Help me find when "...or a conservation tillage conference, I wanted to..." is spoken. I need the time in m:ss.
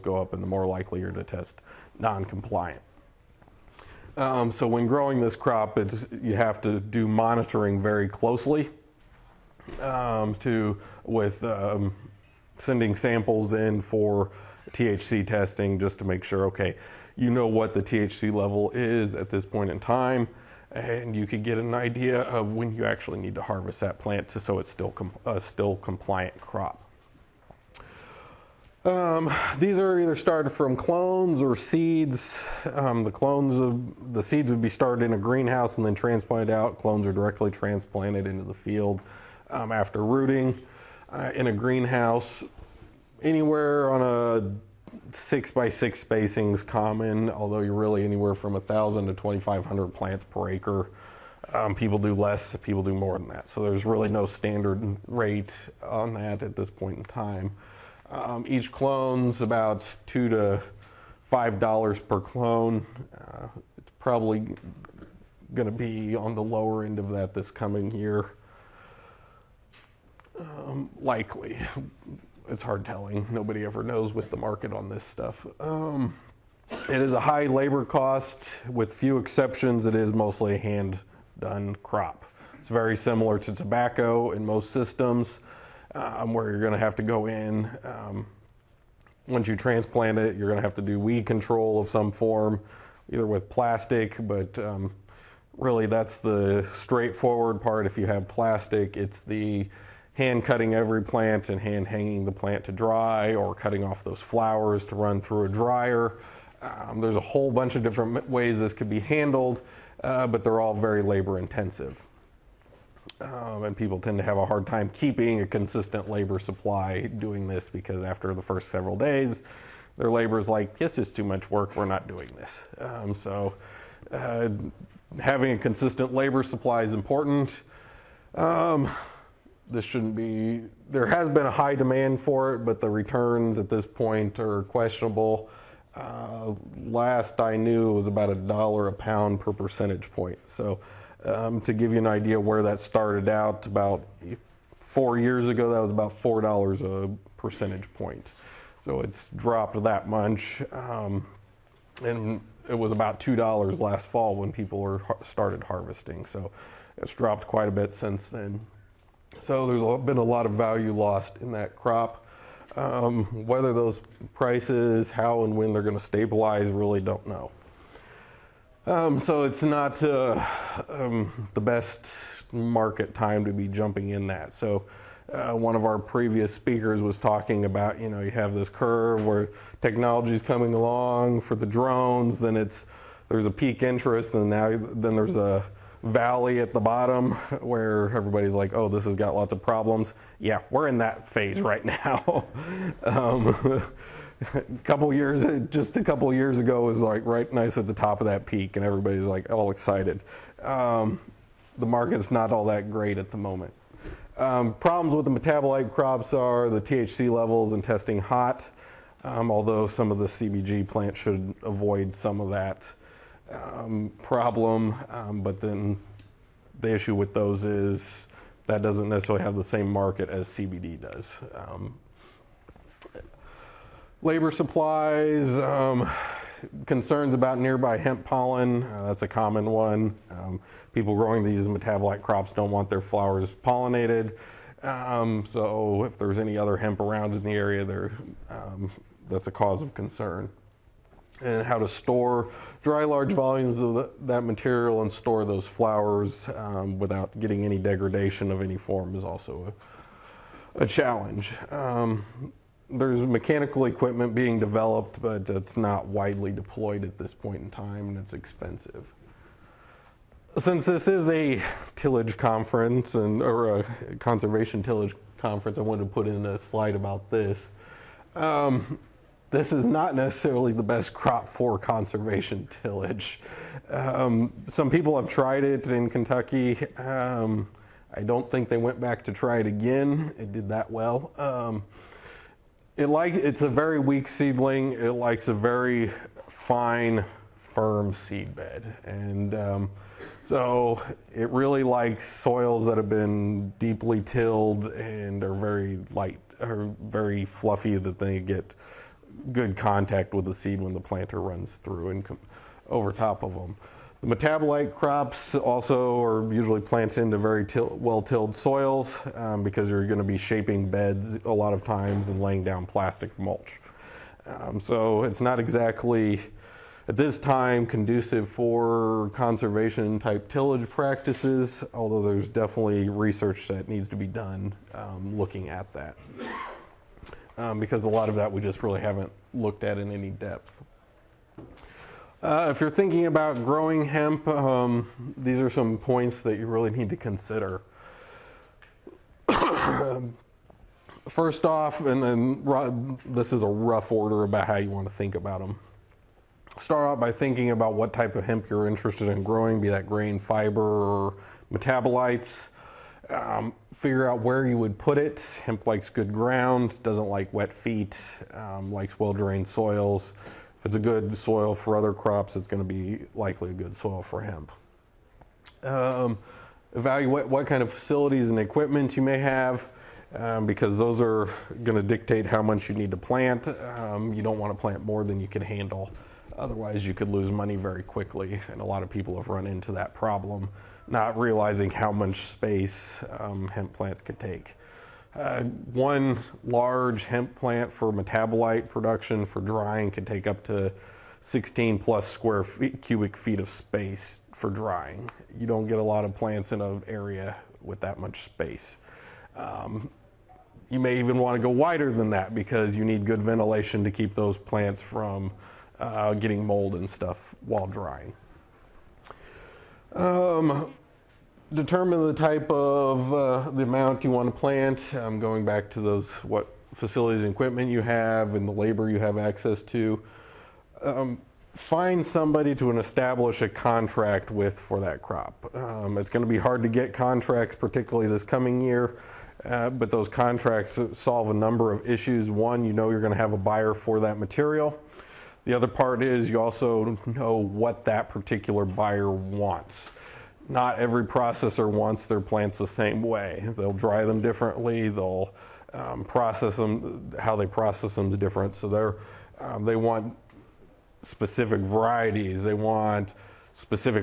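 4:23.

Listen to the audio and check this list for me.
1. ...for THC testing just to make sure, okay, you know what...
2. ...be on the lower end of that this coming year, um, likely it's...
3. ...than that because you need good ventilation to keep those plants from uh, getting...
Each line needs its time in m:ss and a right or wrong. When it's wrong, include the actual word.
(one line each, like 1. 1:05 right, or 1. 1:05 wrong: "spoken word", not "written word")
1. 0:13 right
2. 1:05 right
3. 6:42 right.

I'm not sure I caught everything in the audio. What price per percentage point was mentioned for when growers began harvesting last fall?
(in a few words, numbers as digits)
$2.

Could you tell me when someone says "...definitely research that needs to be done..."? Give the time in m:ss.
5:22.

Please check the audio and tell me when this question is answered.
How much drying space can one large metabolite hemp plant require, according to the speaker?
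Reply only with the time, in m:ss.
6:31.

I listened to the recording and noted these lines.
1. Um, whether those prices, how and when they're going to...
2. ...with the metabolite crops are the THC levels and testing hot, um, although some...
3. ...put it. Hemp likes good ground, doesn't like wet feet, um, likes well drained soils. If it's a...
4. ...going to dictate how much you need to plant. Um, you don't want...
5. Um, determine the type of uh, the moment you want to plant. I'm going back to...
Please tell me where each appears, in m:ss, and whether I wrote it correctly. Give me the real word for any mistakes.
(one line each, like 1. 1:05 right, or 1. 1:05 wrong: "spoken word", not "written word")
1. 2:42 right
2. 3:25 right
3. 5:54 right
4. 6:11 right
5. 6:50 wrong: "amount", not "moment".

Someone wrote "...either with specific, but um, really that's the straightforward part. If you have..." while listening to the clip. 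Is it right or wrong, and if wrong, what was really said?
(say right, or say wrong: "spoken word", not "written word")
wrong: "plastic", not "specific".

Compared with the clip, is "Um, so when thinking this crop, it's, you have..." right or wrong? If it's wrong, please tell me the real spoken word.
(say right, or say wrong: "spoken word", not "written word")
wrong: "growing", not "thinking".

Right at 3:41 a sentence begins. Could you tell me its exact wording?
Um, labor supplies, um, concerns about nearby hemp pollen, uh, that's a common one.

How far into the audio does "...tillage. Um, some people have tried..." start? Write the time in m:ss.
4:32.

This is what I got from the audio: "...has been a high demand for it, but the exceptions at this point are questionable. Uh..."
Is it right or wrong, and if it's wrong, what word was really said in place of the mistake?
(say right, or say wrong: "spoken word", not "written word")
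wrong: "returns", not "exceptions".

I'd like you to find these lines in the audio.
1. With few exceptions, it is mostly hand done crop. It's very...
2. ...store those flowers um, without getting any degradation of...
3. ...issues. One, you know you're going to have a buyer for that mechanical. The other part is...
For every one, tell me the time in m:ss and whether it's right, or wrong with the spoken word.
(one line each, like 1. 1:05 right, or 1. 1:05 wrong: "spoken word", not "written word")
1. 1:18 right
2. 4:05 right
3. 7:12 wrong: "material", not "mechanical".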